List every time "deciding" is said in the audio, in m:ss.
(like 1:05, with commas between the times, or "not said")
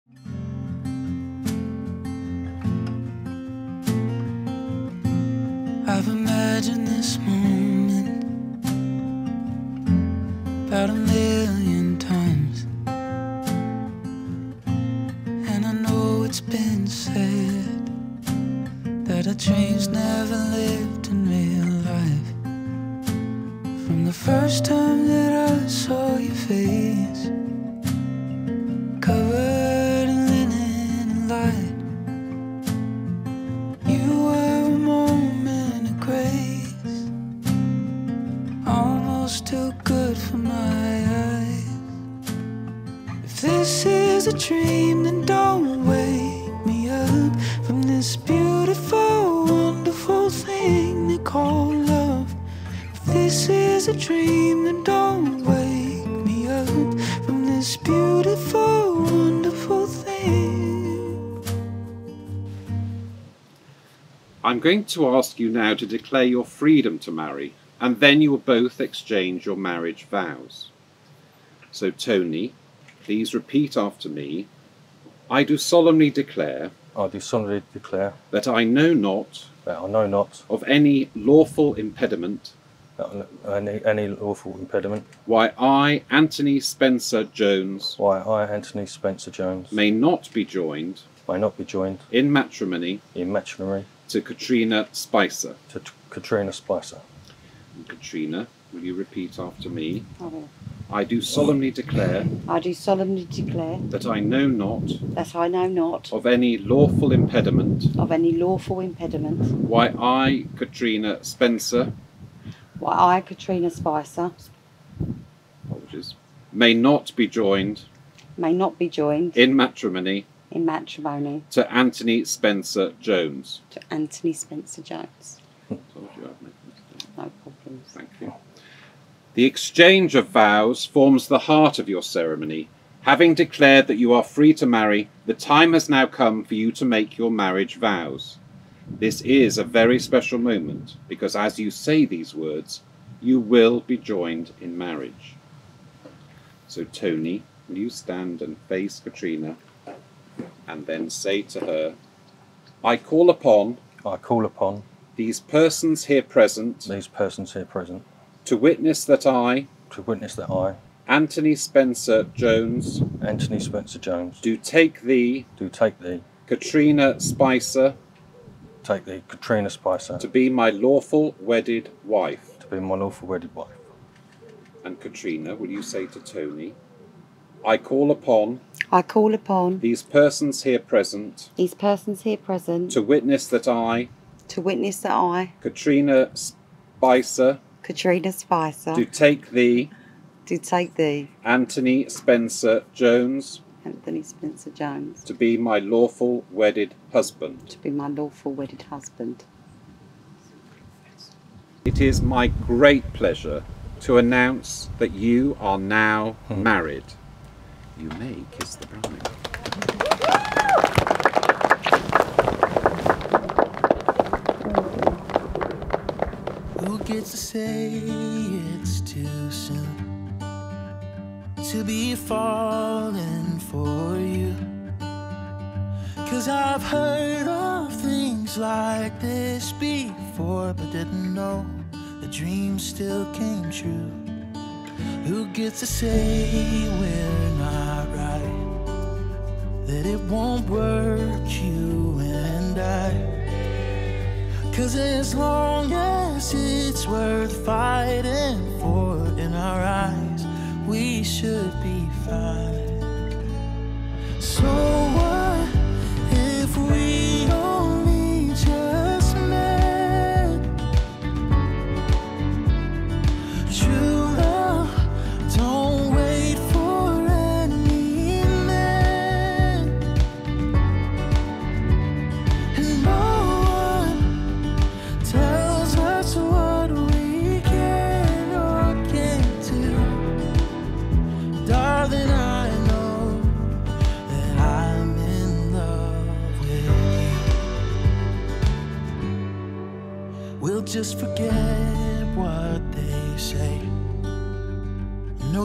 not said.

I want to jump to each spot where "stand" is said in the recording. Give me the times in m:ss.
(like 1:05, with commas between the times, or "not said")
2:27.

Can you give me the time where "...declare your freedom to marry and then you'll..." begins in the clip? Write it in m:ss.
1:05.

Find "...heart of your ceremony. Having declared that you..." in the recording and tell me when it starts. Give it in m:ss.
2:11.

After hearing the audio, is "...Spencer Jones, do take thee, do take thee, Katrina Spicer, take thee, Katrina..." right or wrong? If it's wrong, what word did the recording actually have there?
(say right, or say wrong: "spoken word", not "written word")
right.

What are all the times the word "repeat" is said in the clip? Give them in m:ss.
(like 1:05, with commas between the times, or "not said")
1:13, 1:38.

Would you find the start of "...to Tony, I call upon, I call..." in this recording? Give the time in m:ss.
2:56.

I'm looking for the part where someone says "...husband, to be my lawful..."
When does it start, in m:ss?
3:17.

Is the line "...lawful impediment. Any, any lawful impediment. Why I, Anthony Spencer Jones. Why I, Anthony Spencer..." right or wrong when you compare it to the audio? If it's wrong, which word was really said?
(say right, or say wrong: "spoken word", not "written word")
right.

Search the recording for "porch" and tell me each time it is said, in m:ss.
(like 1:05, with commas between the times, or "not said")
not said.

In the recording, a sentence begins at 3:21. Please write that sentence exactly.
It is my great pleasure to announce that you are now hmm.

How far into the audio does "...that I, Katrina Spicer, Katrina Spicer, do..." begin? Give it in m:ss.
3:04.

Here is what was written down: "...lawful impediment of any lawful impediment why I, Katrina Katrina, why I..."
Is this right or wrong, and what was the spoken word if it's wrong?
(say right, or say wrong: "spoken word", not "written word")
wrong: "Spencer", not "Katrina".